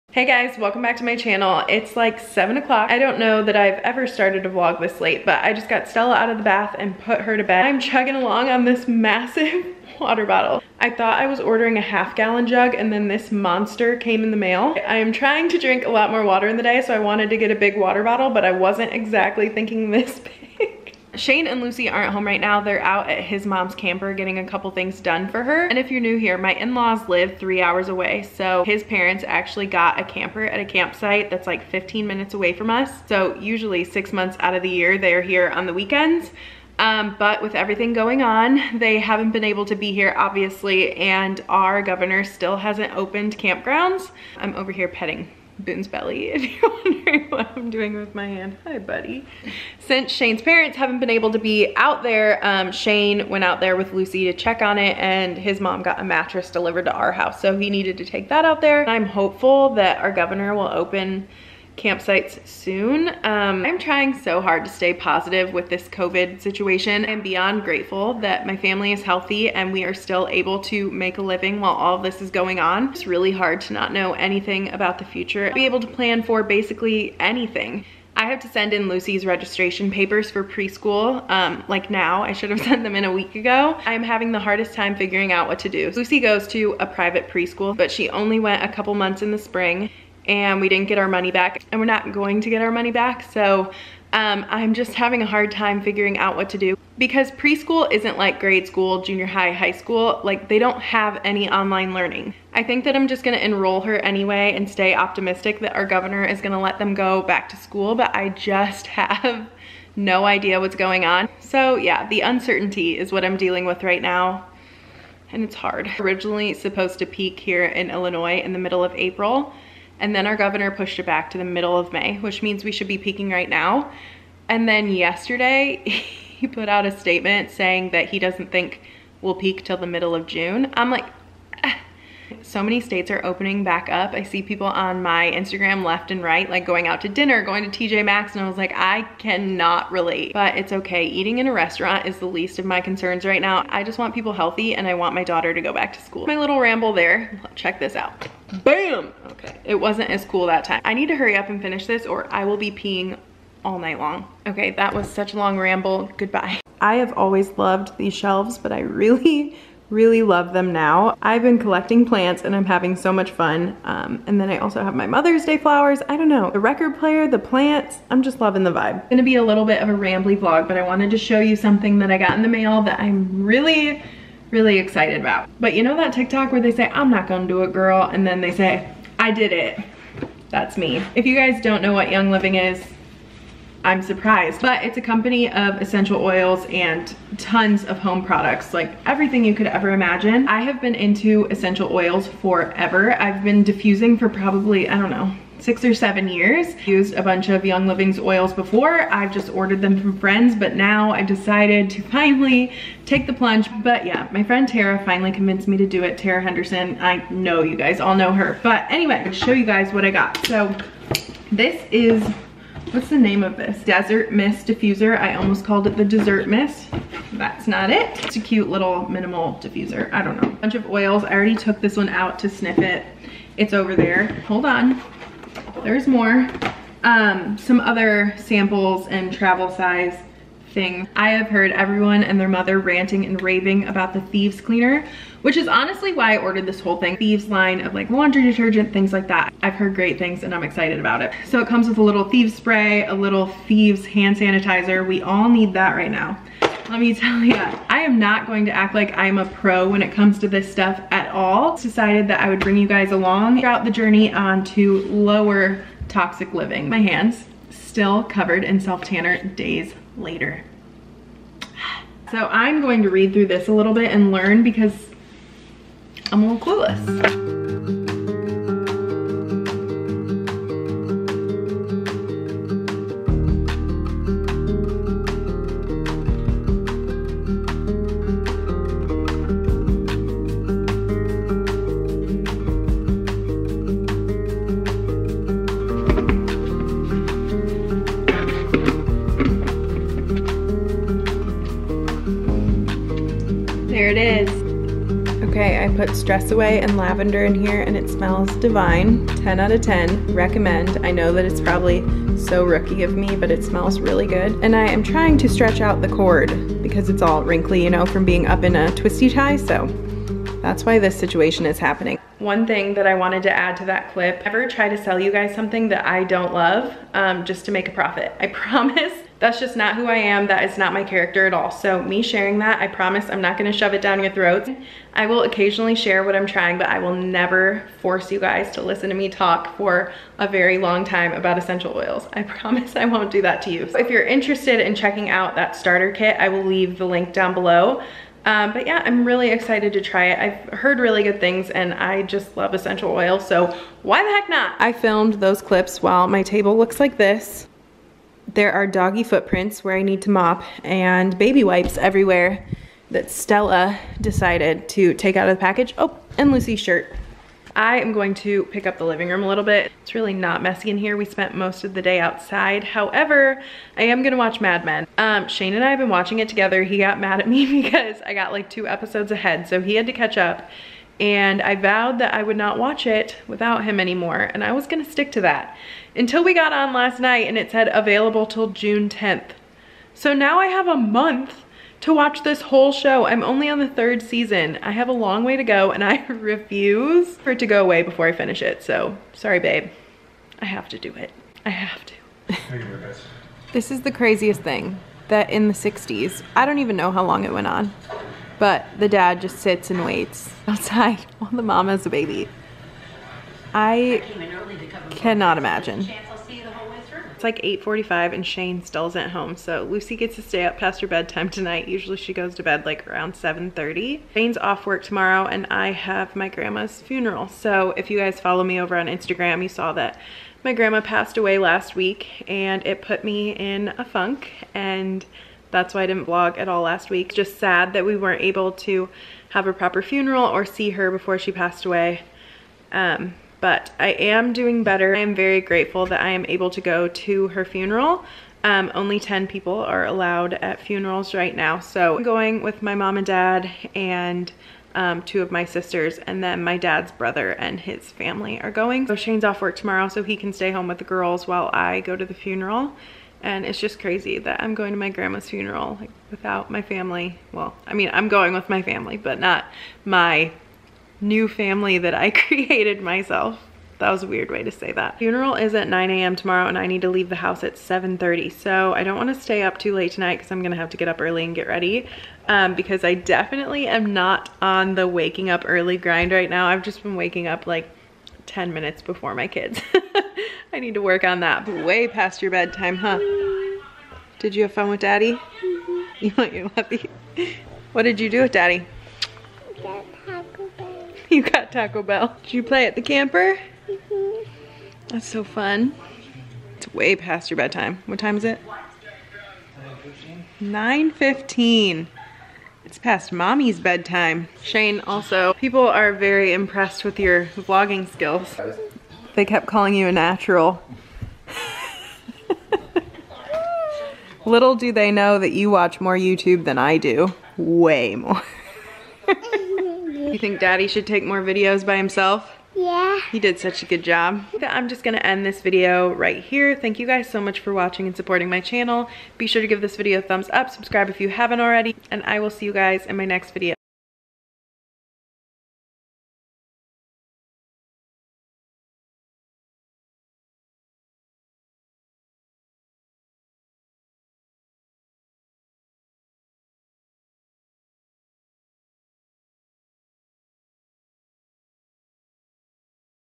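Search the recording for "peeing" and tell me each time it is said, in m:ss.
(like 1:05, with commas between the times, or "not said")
2:32.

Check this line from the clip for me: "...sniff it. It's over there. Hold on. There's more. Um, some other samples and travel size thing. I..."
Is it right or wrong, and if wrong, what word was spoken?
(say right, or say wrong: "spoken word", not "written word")
right.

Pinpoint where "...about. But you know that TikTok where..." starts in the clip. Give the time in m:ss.
2:55.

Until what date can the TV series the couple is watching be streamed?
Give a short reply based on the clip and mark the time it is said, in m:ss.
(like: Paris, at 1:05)
June 10th, at 6:18.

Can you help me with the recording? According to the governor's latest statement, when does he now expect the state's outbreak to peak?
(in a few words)
Middle of June.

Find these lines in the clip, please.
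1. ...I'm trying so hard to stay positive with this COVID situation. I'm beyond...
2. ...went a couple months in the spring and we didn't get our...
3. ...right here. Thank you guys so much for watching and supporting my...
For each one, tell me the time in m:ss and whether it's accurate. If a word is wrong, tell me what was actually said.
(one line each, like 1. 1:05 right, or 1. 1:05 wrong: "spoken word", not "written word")
1. 1:03 right
2. 1:28 right
3. 8:46 right.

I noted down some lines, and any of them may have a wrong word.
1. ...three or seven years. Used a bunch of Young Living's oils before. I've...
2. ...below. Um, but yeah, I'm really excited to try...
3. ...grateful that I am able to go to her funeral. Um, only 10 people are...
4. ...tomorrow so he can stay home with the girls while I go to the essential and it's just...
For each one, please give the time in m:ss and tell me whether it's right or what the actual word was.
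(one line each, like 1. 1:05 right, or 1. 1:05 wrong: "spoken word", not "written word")
1. 3:15 wrong: "six", not "three"
2. 5:37 right
3. 7:15 right
4. 7:29 wrong: "funeral", not "essential".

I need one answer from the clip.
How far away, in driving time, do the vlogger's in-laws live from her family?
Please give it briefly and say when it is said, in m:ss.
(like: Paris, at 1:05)
3 hours, at 0:27.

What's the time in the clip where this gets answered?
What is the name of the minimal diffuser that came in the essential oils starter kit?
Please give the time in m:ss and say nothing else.
3:33.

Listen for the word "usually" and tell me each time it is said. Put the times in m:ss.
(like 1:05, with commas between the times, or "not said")
0:33, 6:51.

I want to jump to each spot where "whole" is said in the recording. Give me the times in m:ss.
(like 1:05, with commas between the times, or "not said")
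3:56, 6:22.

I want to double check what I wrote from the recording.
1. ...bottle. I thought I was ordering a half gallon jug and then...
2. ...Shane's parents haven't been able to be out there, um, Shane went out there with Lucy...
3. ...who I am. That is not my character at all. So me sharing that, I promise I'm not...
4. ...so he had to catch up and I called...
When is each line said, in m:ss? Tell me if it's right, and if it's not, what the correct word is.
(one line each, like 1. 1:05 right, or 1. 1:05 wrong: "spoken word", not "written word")
1. 0:10 right
2. 0:50 right
3. 5:19 right
4. 6:09 wrong: "vowed", not "called".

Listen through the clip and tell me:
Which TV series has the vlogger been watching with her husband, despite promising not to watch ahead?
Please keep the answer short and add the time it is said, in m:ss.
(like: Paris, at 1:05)
Mad Men, at 6:04.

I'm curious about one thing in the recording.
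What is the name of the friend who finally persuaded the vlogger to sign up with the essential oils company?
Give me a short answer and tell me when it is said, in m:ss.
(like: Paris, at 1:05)
Tara Henderson, at 3:26.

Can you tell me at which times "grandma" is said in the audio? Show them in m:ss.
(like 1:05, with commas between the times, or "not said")
6:56, 7:00, 7:35.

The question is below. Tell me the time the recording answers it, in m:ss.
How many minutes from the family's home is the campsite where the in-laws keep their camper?
0:31.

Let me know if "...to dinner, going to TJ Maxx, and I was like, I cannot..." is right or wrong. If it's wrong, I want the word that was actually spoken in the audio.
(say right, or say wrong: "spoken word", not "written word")
right.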